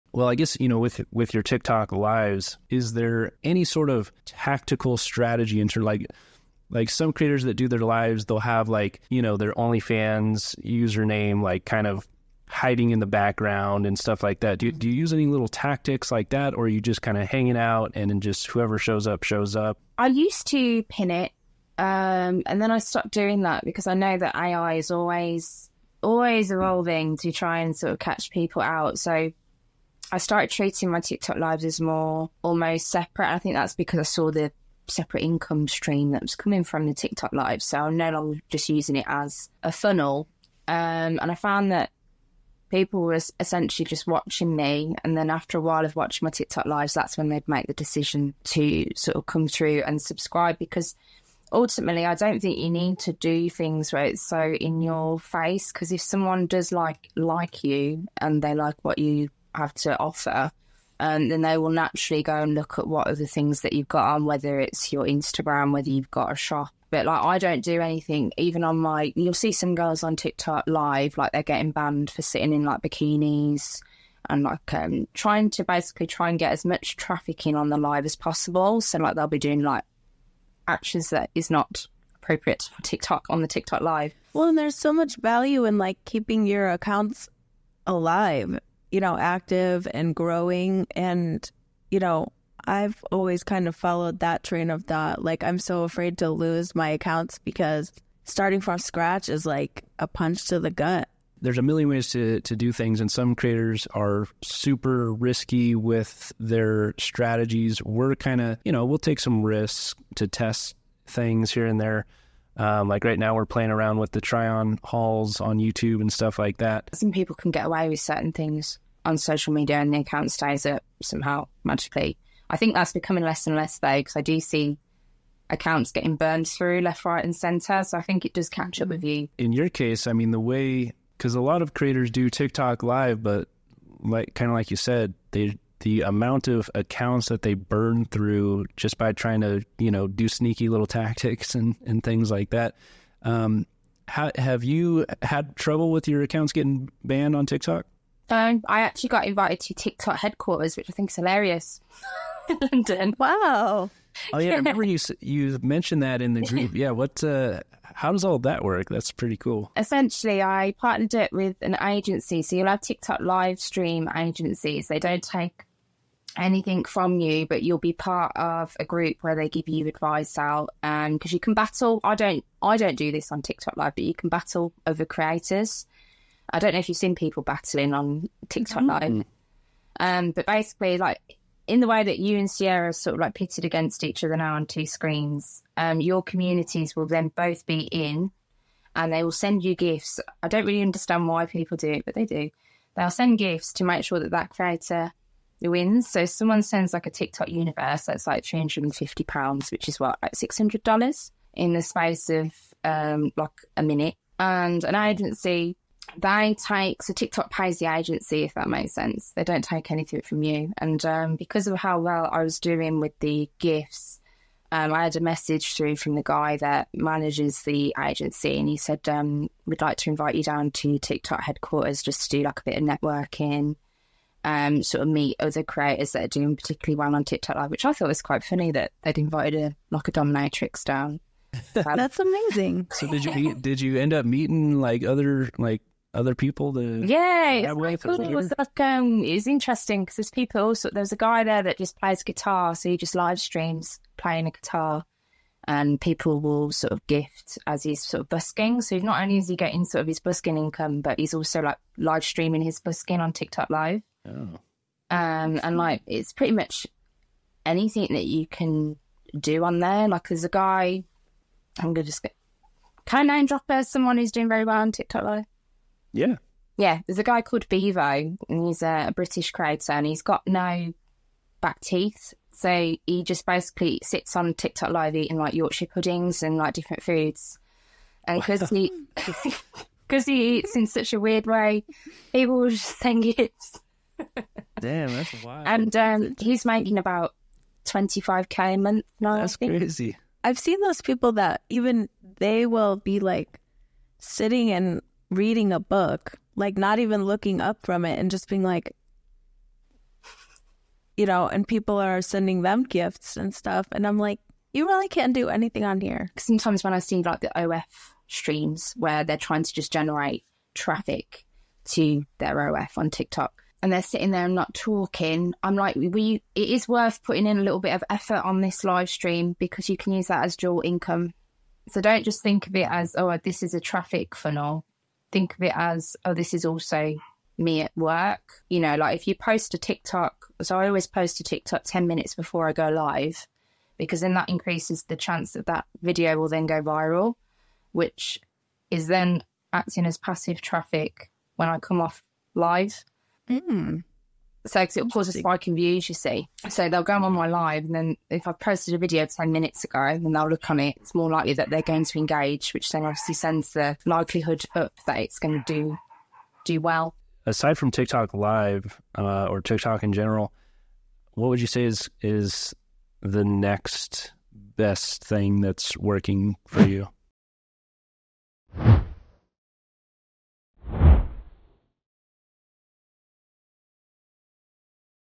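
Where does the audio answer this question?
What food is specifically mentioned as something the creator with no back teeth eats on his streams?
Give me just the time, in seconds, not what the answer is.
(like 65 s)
275 s.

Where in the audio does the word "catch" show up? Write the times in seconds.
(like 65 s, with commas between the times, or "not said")
27 s, 128 s.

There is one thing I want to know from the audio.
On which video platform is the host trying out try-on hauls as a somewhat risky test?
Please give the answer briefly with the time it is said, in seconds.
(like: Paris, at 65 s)
YouTube, at 115 s.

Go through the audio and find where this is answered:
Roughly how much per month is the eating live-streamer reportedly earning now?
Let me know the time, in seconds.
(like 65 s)
287 s.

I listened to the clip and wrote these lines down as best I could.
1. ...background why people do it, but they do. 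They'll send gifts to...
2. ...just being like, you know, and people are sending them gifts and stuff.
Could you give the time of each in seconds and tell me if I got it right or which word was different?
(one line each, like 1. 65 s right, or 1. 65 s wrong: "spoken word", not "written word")
1. 190 s wrong: "understand", not "background"
2. 298 s right.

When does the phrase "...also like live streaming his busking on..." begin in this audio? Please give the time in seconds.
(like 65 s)
251 s.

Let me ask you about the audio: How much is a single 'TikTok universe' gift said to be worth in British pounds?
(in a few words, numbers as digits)
£350.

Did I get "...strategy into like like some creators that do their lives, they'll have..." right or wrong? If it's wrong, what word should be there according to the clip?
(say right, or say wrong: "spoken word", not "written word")
right.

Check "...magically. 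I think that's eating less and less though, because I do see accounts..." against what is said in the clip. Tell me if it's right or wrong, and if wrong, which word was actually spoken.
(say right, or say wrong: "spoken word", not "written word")
wrong: "becoming", not "eating".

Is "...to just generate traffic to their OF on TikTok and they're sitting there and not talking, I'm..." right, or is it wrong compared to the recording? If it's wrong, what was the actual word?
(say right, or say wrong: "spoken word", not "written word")
right.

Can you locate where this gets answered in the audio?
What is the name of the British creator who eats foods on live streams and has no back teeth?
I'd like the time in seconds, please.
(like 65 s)
267 s.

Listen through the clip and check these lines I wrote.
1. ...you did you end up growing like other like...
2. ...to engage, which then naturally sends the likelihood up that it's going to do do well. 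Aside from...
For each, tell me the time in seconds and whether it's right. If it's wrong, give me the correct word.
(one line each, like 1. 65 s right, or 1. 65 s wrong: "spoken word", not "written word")
1. 233 s wrong: "meeting", not "growing"
2. 352 s wrong: "obviously", not "naturally".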